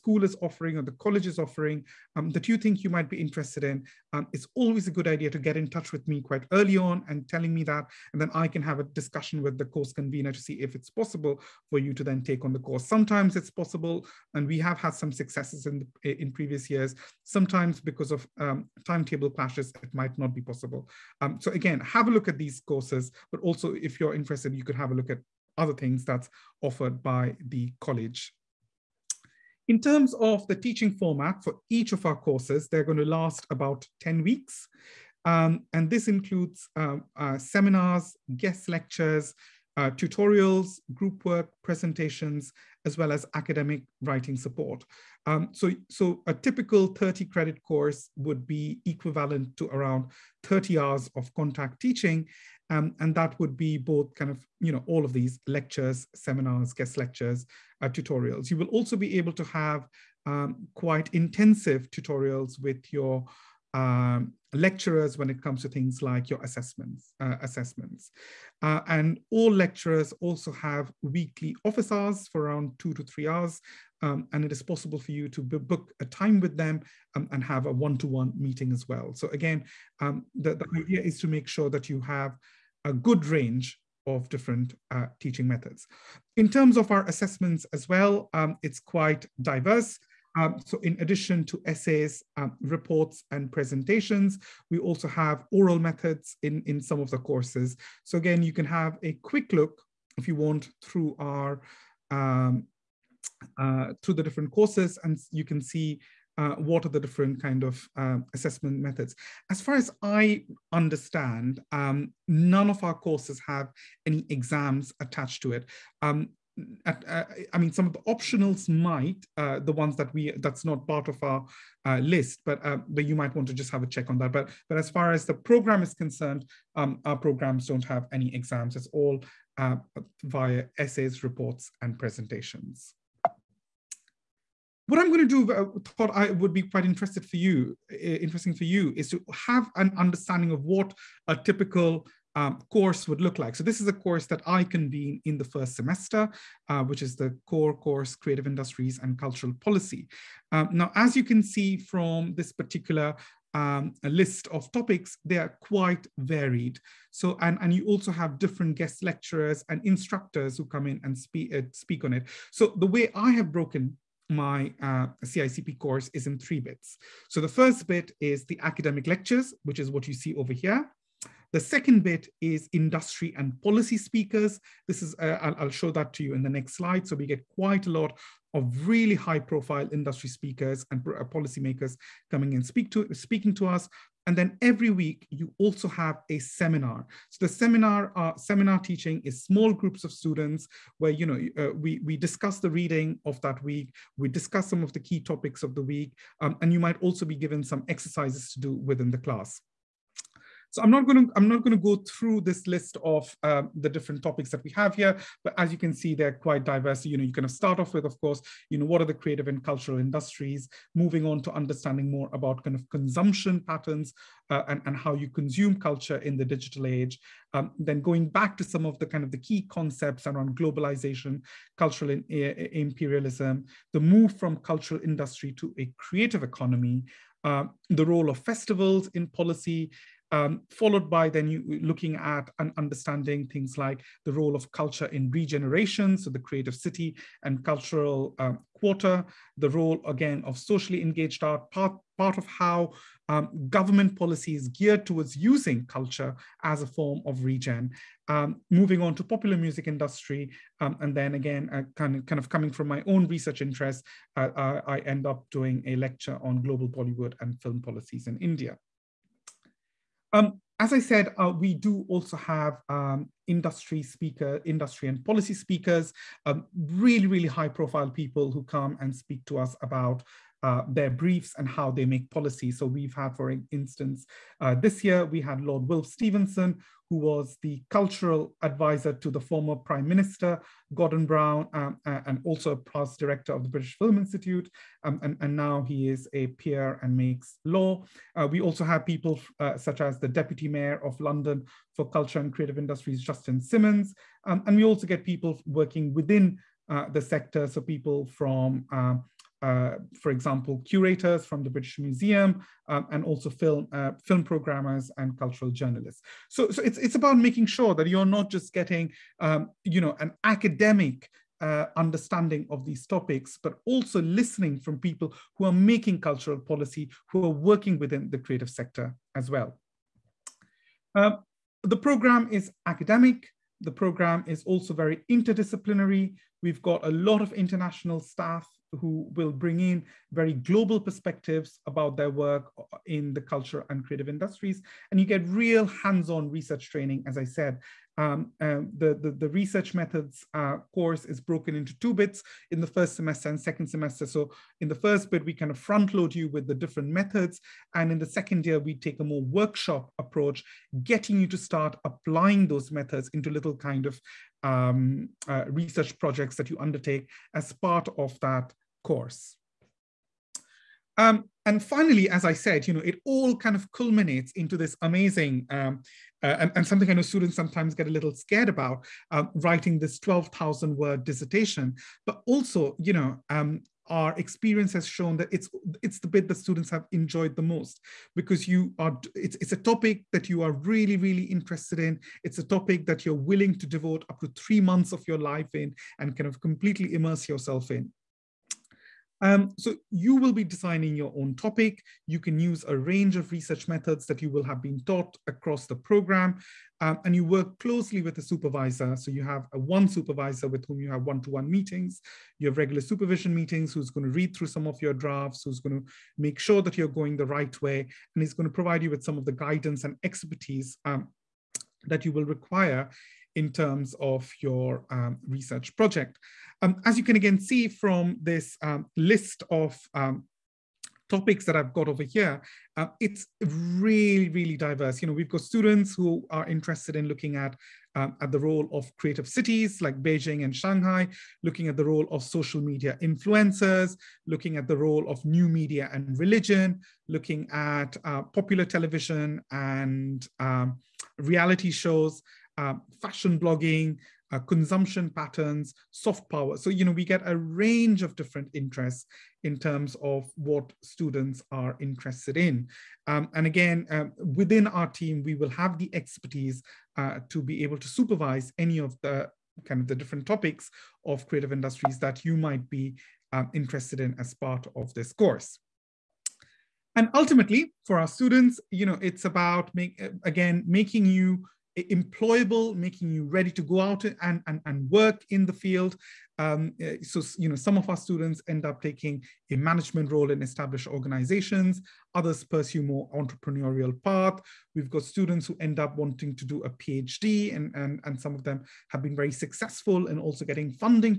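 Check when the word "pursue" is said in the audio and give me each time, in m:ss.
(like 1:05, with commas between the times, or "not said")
8:02.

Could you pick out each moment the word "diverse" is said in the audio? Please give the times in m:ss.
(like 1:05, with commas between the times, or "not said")
1:29, 3:26, 7:04.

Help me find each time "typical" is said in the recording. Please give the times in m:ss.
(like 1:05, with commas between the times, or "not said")
0:46, 2:21.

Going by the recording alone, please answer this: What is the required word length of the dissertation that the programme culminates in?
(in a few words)
12,000.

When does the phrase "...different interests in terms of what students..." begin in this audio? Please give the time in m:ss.
7:28.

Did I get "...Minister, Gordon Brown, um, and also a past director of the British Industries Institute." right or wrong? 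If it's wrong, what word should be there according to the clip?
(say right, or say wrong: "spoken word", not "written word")
wrong: "Film", not "Industries".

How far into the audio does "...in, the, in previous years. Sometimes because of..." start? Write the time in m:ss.
0:15.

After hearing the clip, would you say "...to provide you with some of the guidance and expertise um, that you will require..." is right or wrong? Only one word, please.
right.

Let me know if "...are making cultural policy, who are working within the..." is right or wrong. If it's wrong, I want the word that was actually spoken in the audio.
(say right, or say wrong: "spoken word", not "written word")
right.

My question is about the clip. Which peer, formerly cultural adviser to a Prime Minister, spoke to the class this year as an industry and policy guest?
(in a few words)
Lord Wilf Stevenson.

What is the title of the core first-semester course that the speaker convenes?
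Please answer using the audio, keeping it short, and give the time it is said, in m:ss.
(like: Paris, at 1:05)
Creative Industries and Cultural Policy, at 2:28.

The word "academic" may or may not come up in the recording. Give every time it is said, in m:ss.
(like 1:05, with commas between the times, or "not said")
0:43, 2:48, 5:10, 5:22.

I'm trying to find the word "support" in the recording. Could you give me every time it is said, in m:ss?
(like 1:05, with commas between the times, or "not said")
0:44.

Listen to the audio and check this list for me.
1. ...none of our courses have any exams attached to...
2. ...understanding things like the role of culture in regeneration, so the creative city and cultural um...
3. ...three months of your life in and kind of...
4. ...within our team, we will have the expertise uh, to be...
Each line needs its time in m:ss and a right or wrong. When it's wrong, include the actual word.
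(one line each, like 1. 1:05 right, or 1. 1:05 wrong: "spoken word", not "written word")
1. 1:52 right
2. 3:52 right
3. 6:24 right
4. 7:34 right.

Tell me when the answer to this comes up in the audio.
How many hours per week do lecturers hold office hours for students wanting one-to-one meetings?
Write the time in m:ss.
1:12.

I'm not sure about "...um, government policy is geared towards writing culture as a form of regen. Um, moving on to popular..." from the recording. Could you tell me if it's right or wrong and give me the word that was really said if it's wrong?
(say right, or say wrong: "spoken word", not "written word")
wrong: "using", not "writing".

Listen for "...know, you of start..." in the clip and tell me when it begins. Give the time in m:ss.
3:27.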